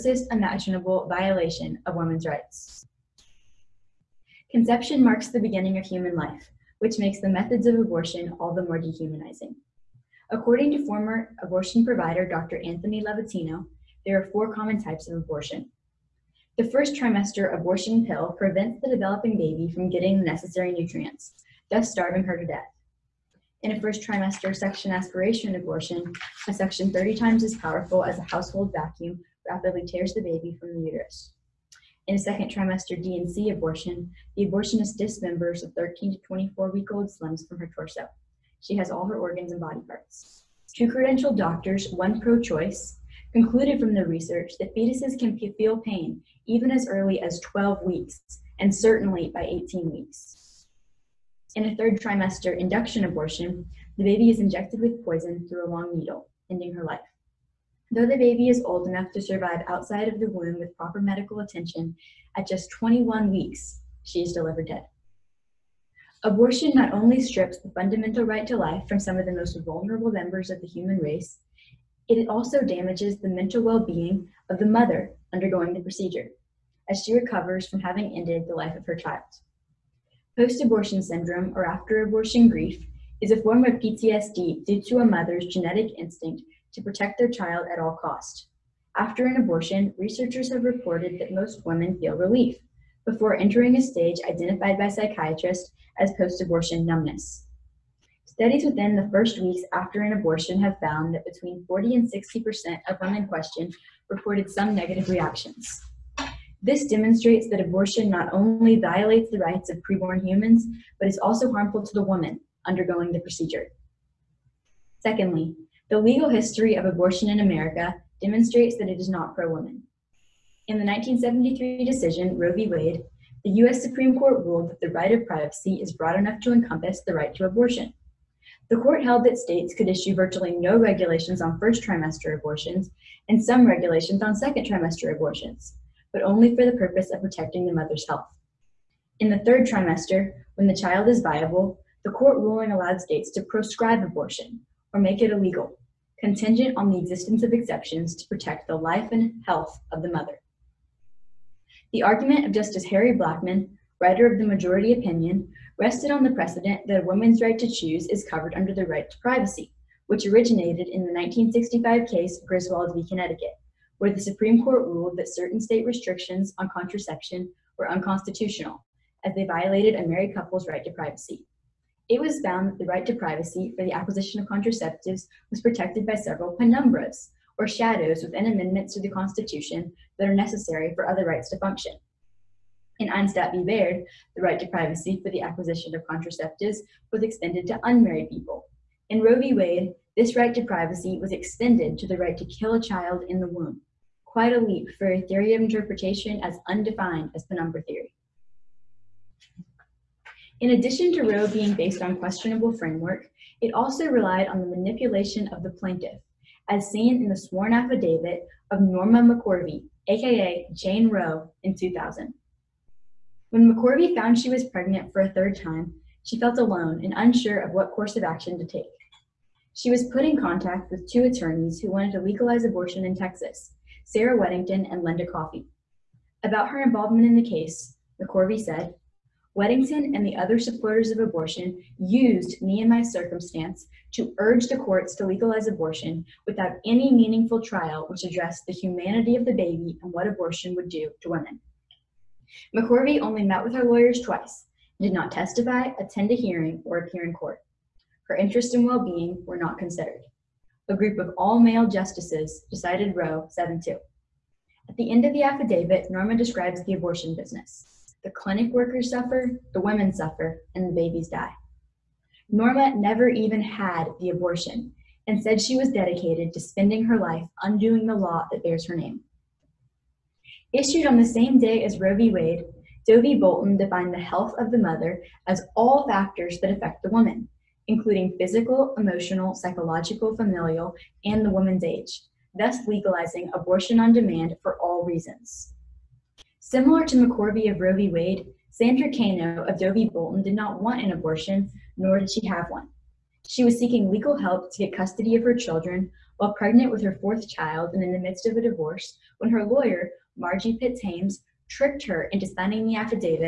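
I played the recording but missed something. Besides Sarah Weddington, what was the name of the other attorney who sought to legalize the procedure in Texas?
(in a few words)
Linda Coffey.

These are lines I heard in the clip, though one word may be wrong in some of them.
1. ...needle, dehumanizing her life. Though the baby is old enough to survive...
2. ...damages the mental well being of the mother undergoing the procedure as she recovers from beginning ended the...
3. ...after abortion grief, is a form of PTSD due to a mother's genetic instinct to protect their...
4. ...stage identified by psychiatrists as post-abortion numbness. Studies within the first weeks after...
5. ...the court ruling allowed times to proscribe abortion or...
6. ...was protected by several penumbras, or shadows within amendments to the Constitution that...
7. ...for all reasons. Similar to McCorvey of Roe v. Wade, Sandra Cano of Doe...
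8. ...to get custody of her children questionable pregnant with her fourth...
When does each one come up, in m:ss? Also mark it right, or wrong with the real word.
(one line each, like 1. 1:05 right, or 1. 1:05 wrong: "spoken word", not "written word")
1. 0:55 wrong: "ending", not "dehumanizing"
2. 1:12 wrong: "having", not "beginning"
3. 1:21 right
4. 1:33 right
5. 2:22 wrong: "states", not "times"
6. 2:55 right
7. 4:44 right
8. 4:54 wrong: "while", not "questionable".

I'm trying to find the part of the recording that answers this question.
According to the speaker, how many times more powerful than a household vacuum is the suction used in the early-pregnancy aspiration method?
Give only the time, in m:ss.
0:26.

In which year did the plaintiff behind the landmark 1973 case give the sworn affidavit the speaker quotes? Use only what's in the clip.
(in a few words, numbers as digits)
2000.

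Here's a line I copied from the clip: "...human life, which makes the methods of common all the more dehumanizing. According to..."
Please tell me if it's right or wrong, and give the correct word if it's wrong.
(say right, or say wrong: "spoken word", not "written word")
wrong: "abortion", not "common".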